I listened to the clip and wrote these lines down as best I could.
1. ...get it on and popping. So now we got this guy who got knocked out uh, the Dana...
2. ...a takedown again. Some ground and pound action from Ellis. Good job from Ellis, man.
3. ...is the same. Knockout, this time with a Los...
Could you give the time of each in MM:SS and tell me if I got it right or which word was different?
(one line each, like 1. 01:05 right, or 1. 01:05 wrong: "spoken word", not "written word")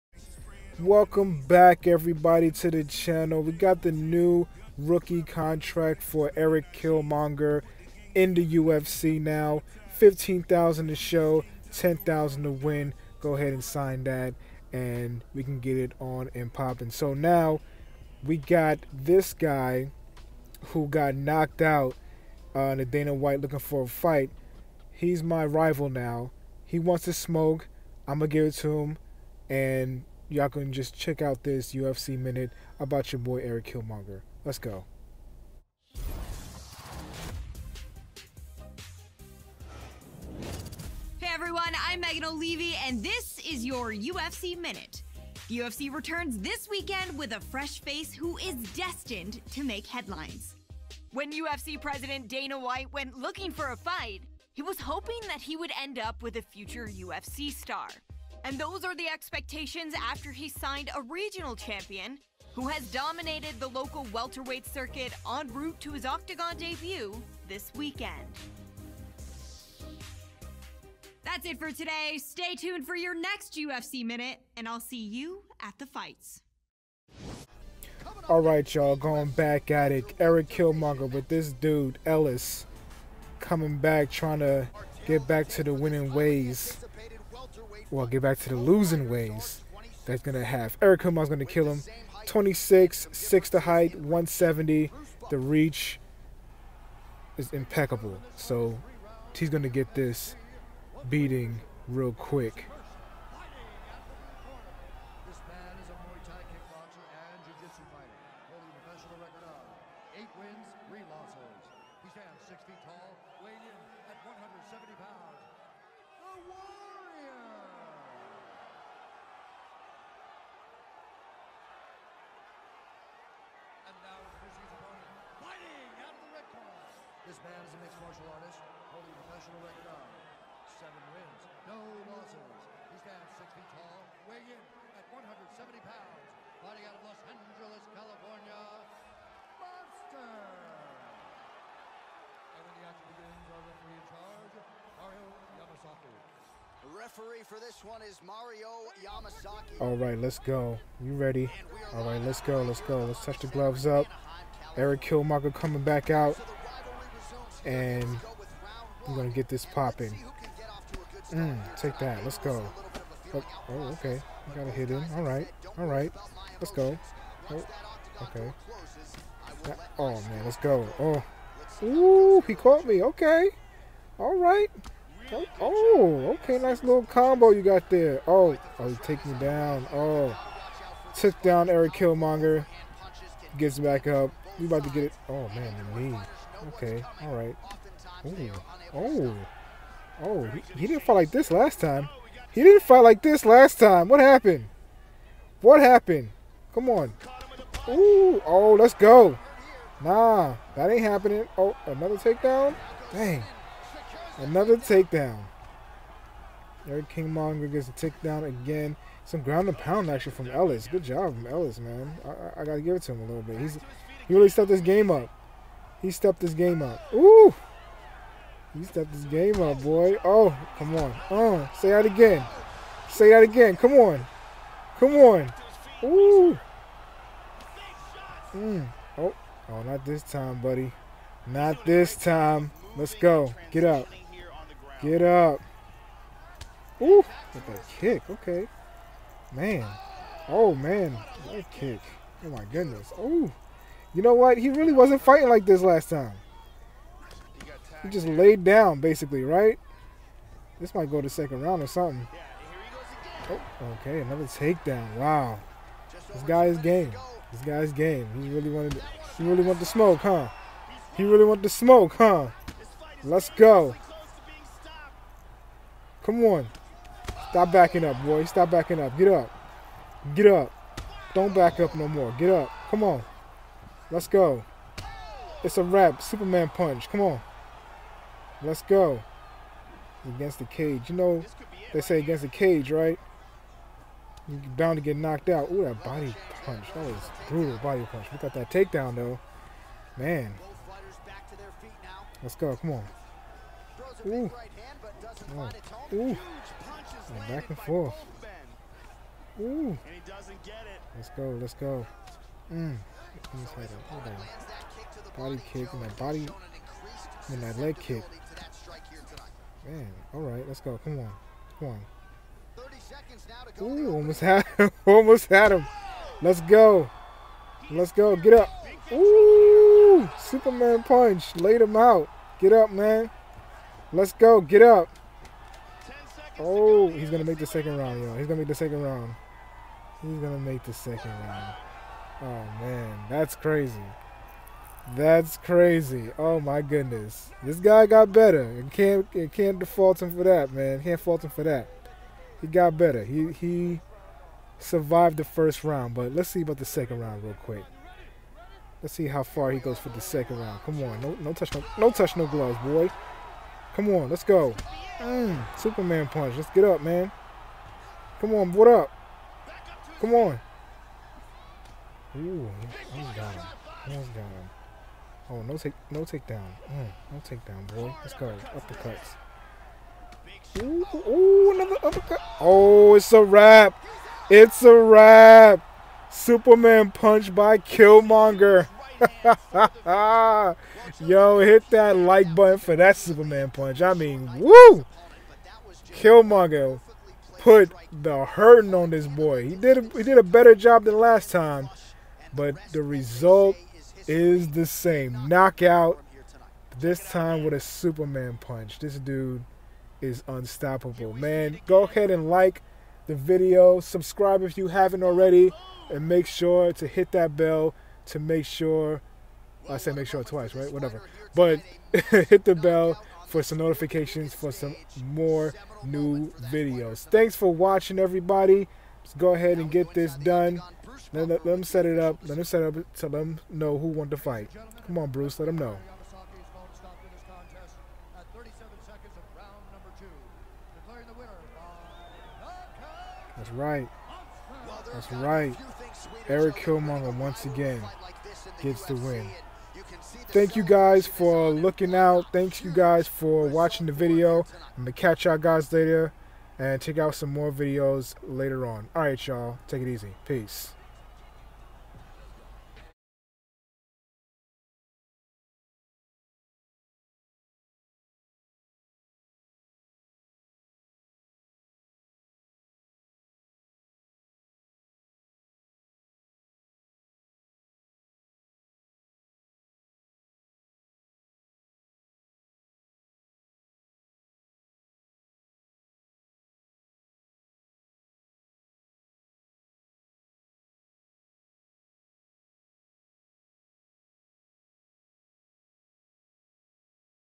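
1. 00:15 right
2. 03:27 right
3. 06:34 wrong: "Superman", not "Los".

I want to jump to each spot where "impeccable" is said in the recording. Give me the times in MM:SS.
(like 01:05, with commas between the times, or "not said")
01:37.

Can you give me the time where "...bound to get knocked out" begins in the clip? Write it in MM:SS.
04:44.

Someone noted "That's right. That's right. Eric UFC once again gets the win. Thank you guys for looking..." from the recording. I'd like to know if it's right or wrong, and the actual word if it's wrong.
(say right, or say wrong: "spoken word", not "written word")
wrong: "Killmonger", not "UFC".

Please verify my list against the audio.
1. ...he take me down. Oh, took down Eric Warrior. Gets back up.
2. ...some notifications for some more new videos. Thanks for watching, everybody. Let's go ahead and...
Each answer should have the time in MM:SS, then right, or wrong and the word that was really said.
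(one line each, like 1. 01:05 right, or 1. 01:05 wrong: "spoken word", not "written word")
1. 02:58 wrong: "Killmonger", not "Warrior"
2. 06:53 right.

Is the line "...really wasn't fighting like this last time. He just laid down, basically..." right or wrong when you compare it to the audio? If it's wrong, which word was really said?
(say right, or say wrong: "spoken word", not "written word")
right.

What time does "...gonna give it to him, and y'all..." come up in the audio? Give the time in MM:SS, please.
00:28.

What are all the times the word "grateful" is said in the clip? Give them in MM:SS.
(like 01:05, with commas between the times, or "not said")
not said.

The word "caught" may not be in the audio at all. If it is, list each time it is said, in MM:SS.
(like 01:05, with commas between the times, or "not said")
02:52.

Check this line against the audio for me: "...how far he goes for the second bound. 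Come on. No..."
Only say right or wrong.
wrong.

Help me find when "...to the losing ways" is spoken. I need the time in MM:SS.
01:28.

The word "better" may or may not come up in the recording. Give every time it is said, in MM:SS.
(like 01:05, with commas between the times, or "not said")
05:38, 05:42, 06:30.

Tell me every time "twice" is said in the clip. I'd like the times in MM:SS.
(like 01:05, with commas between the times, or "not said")
06:50.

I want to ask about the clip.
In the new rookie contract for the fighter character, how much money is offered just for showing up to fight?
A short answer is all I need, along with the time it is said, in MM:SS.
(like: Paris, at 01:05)
15000, at 00:09.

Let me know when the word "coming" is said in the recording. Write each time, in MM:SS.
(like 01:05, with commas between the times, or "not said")
01:23, 02:35.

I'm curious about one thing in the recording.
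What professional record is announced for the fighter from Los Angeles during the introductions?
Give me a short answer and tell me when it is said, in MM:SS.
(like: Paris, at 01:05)
seven wins, no losses, at 02:10.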